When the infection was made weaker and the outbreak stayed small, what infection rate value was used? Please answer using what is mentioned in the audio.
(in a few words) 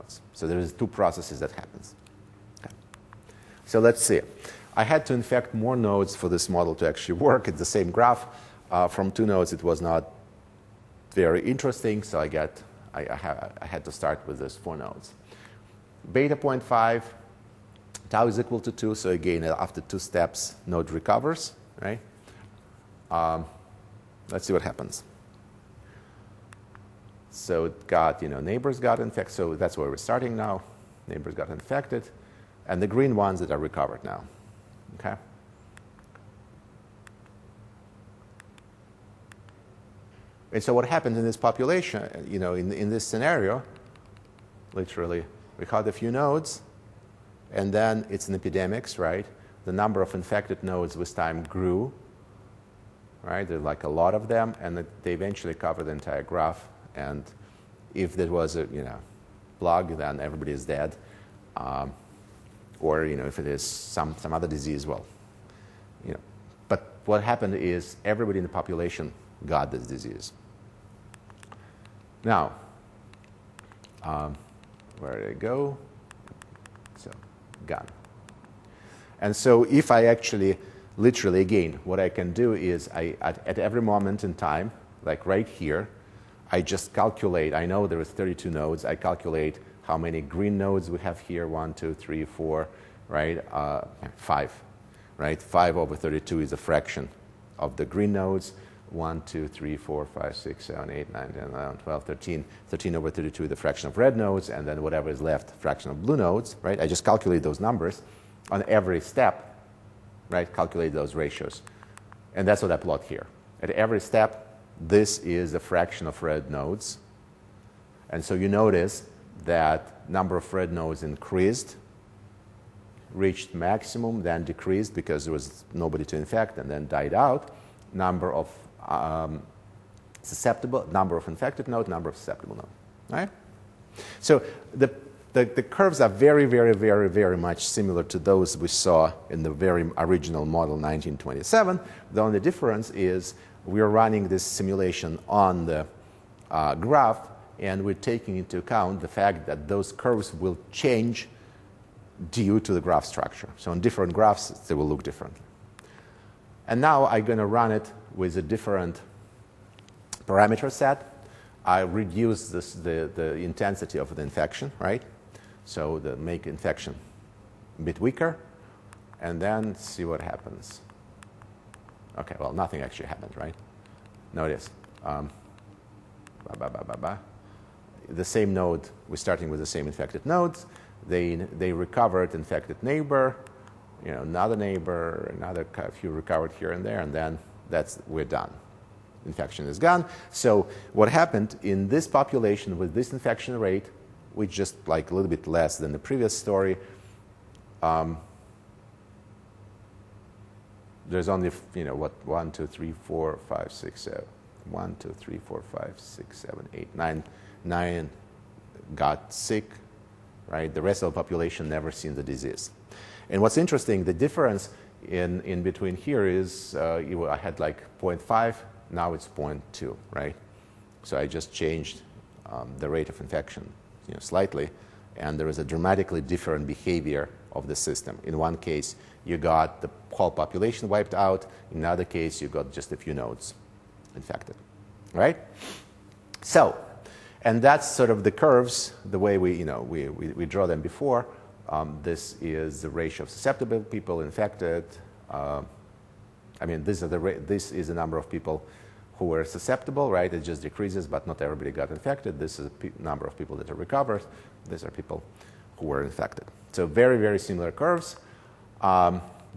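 0.2.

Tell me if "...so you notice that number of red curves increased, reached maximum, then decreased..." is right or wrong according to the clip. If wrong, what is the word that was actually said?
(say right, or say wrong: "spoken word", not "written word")
wrong: "nodes", not "curves".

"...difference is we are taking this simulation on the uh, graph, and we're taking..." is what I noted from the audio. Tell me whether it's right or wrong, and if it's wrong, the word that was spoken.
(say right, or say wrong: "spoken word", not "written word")
wrong: "running", not "taking".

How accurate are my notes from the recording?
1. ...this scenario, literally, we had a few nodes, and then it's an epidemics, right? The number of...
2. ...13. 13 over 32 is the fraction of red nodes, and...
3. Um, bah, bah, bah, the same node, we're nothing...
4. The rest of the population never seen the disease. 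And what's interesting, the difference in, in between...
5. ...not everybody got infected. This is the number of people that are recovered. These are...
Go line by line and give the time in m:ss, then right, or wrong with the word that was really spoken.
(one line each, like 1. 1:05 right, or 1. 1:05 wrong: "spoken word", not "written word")
1. 0:42 right
2. 1:42 right
3. 2:55 wrong: "starting", not "nothing"
4. 3:30 right
5. 4:11 right.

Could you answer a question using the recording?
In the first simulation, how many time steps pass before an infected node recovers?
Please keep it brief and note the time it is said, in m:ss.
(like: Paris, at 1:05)
2, at 0:18.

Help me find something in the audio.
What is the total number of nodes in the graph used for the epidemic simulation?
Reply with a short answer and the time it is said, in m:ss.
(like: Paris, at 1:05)
32, at 1:28.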